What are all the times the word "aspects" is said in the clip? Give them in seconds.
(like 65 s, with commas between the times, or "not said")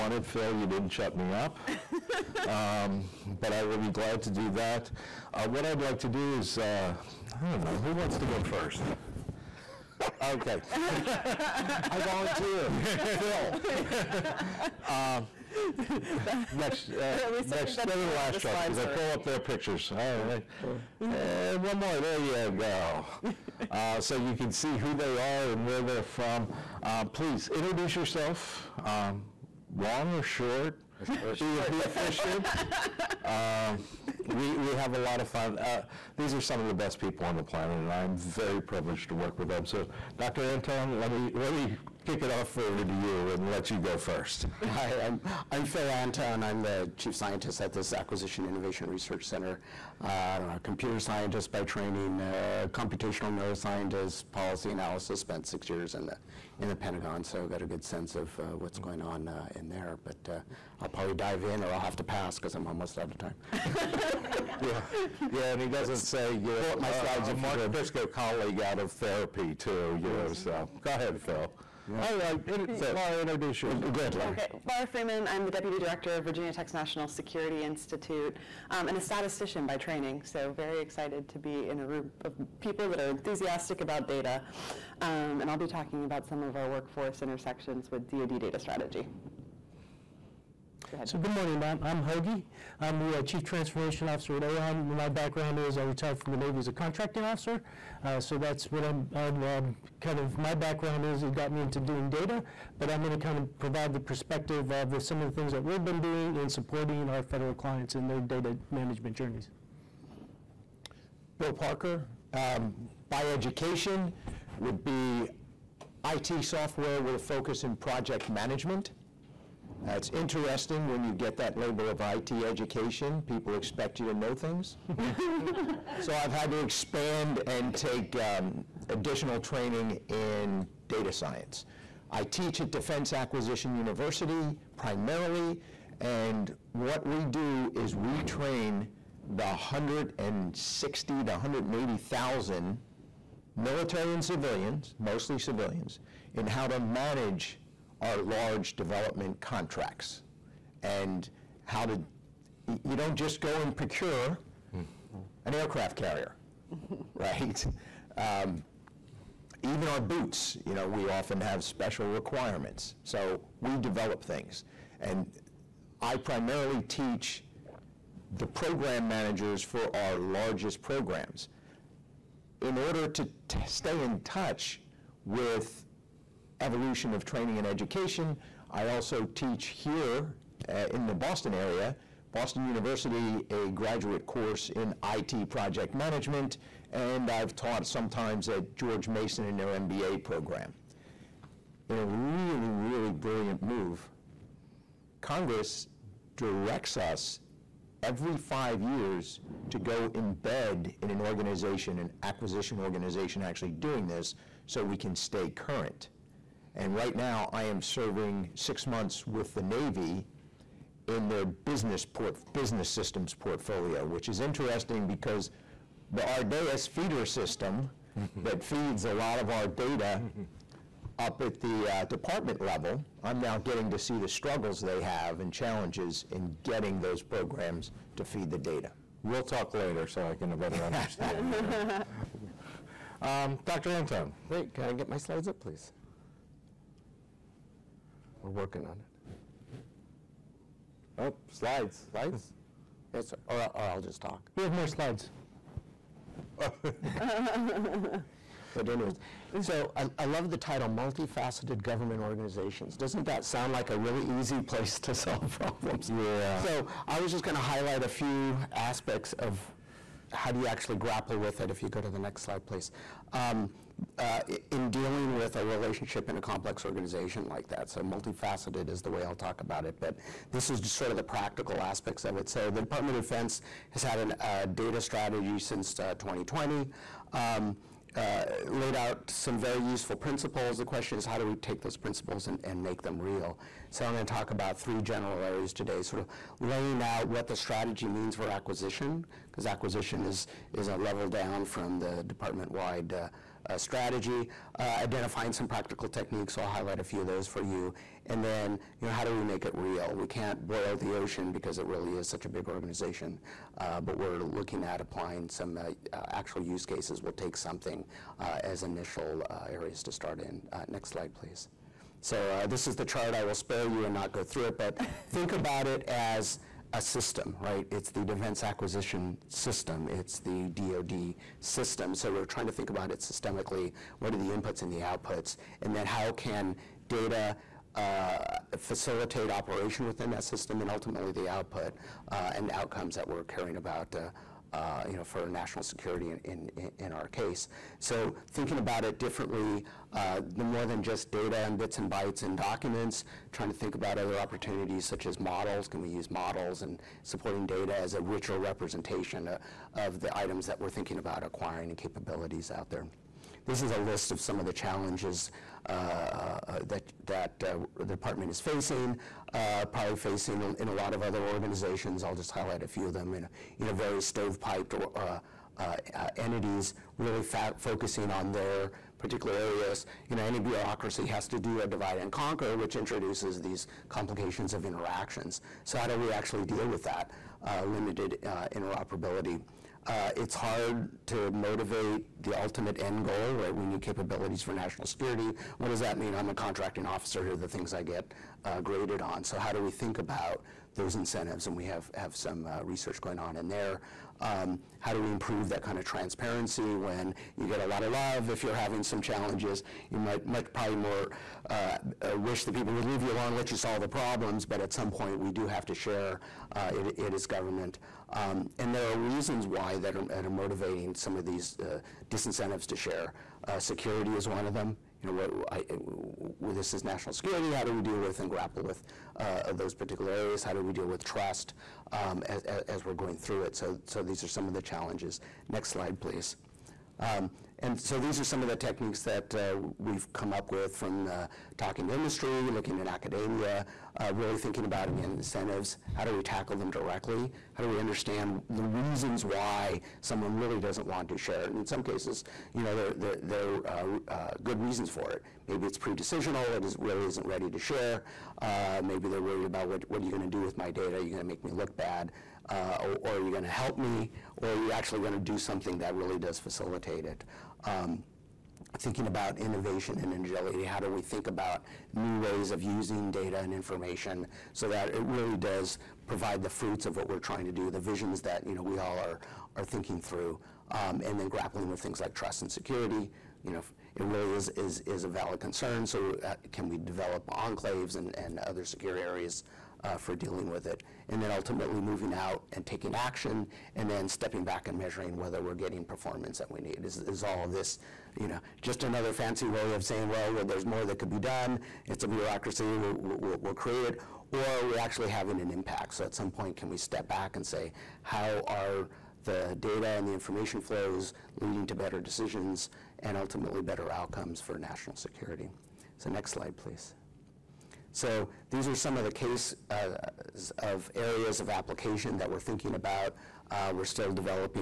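258 s, 271 s.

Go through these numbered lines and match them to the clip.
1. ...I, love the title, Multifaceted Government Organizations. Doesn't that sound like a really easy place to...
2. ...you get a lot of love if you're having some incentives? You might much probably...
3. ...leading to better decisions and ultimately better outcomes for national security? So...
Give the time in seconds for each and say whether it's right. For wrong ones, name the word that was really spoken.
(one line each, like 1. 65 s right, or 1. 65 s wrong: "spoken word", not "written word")
1. 250 s right
2. 397 s wrong: "challenges", not "incentives"
3. 501 s right.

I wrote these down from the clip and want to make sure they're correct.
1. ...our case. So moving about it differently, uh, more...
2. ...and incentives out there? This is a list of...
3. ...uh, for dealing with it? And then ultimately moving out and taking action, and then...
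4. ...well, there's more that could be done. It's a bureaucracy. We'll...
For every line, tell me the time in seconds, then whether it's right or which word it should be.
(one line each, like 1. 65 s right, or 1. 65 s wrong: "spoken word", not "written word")
1. 337 s wrong: "thinking", not "moving"
2. 351 s wrong: "capabilities", not "incentives"
3. 480 s right
4. 490 s right.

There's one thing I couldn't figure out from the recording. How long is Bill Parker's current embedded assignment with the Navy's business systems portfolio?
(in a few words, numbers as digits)
6 months.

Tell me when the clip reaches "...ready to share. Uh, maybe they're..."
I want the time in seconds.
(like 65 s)
447 s.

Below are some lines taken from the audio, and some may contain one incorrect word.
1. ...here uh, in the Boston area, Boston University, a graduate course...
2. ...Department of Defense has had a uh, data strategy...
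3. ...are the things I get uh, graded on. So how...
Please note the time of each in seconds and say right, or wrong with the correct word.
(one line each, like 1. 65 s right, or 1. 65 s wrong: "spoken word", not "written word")
1. 179 s right
2. 272 s right
3. 387 s right.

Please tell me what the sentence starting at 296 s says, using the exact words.
I'll highlight a few of those for you.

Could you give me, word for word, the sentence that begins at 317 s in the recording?
It's the defense acquisition system, it's the DoD system.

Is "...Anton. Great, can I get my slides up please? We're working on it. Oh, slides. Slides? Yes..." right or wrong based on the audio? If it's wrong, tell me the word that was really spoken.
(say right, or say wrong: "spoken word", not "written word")
right.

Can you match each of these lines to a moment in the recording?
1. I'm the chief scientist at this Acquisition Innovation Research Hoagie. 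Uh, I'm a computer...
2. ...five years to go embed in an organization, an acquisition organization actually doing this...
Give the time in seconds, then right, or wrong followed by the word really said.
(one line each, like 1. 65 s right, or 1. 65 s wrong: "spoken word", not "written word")
1. 46 s wrong: "Center", not "Hoagie"
2. 198 s right.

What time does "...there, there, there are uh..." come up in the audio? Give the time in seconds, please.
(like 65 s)
442 s.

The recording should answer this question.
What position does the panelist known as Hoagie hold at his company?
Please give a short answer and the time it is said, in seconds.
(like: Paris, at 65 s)
Chief Transformation Officer, at 93 s.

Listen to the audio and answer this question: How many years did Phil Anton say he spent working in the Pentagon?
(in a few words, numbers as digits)
6.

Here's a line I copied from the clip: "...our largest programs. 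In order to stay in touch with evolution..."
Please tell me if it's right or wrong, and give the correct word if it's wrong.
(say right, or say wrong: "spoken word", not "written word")
right.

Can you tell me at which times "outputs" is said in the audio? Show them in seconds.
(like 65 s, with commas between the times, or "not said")
324 s, 331 s.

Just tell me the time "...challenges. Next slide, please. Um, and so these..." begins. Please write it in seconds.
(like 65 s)
424 s.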